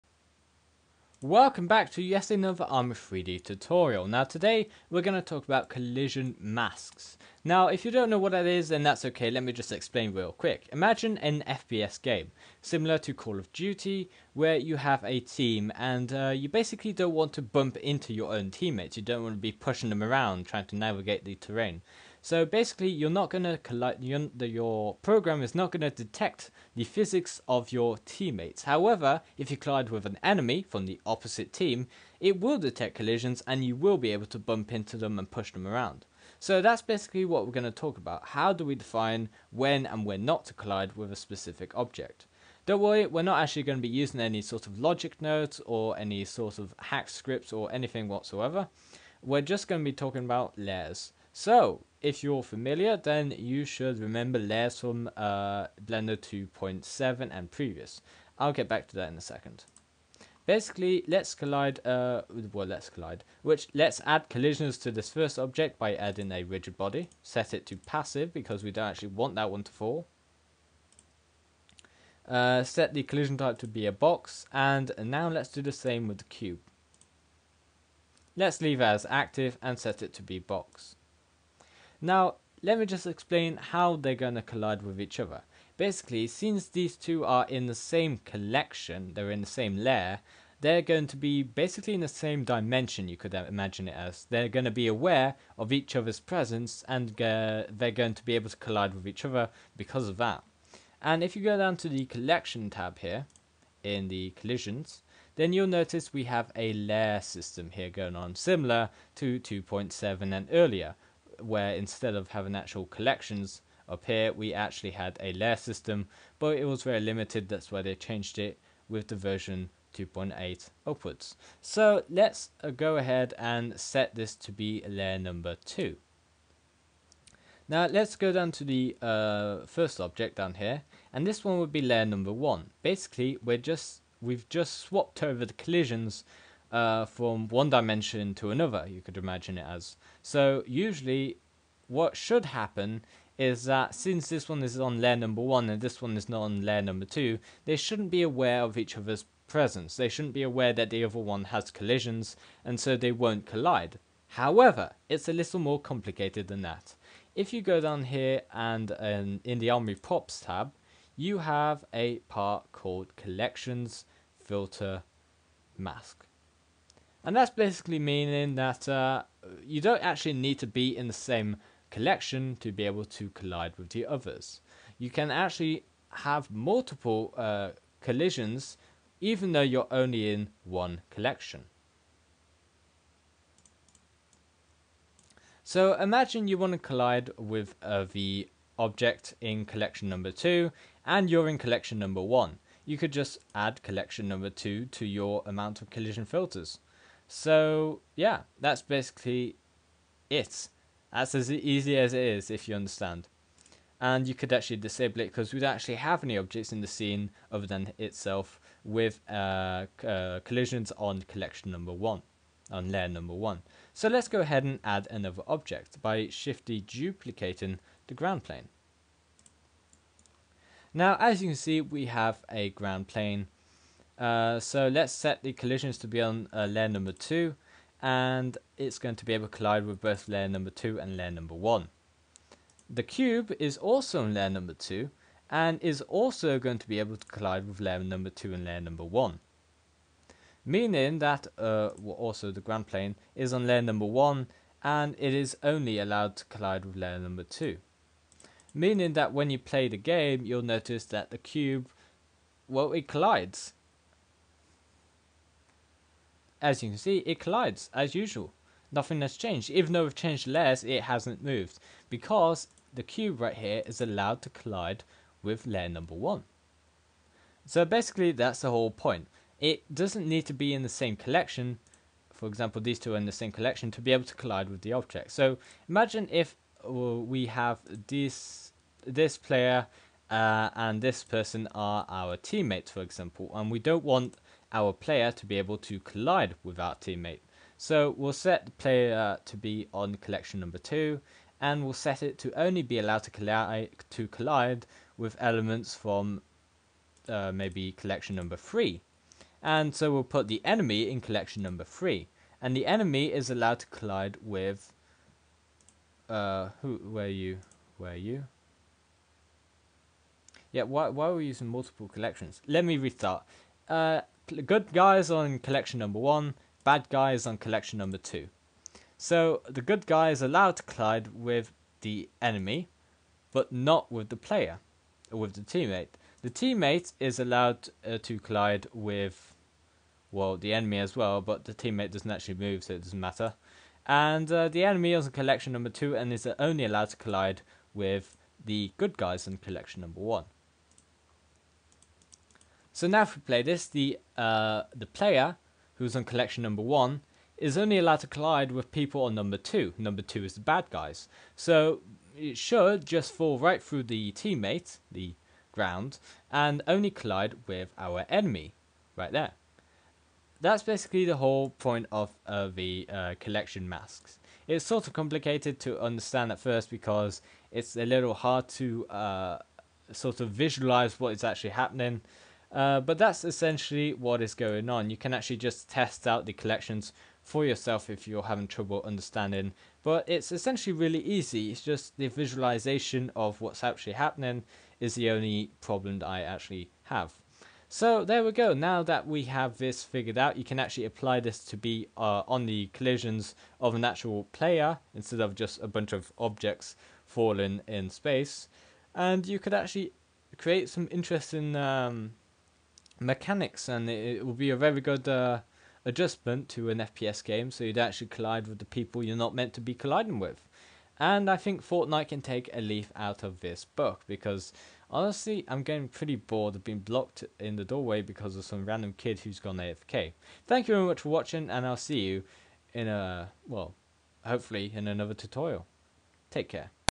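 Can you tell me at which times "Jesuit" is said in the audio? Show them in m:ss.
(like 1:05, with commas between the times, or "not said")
not said.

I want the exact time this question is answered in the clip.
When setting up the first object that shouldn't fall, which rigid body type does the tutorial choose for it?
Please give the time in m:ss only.
1:07.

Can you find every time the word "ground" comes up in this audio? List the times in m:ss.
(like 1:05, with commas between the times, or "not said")
3:38, 3:42, 4:02, 5:55.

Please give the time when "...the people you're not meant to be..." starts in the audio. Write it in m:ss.
6:48.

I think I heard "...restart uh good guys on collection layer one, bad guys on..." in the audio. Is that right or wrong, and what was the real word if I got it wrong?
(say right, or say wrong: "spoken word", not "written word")
wrong: "number", not "layer".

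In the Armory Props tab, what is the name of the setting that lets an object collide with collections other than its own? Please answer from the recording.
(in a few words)
Collections Filter Mask.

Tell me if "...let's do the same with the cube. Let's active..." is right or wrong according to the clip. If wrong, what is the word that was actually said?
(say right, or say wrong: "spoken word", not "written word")
wrong: "leave", not "active".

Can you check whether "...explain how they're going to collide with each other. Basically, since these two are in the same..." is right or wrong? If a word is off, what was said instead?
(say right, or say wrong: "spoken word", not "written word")
right.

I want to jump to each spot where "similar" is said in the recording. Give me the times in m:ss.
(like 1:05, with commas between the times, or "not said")
0:12, 1:48.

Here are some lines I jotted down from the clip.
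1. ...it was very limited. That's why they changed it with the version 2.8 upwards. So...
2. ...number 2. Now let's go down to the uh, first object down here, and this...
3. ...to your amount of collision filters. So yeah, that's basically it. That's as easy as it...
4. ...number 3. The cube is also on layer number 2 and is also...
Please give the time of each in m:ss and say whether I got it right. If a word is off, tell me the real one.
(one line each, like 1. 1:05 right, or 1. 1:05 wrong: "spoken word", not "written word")
1. 1:56 right
2. 2:05 right
3. 3:14 right
4. 3:51 wrong: "1", not "3".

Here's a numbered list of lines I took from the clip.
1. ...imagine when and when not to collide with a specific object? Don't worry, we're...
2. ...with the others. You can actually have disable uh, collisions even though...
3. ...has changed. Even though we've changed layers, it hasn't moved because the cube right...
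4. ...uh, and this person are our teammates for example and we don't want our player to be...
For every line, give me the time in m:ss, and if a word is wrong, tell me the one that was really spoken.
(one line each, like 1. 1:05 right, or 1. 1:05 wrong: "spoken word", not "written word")
1. 0:38 wrong: "define", not "imagine"
2. 2:53 wrong: "multiple", not "disable"
3. 4:19 right
4. 4:40 right.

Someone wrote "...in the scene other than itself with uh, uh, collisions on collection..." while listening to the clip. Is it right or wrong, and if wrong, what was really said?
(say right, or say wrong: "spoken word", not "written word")
right.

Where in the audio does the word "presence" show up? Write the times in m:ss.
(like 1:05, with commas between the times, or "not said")
1:36, 2:29.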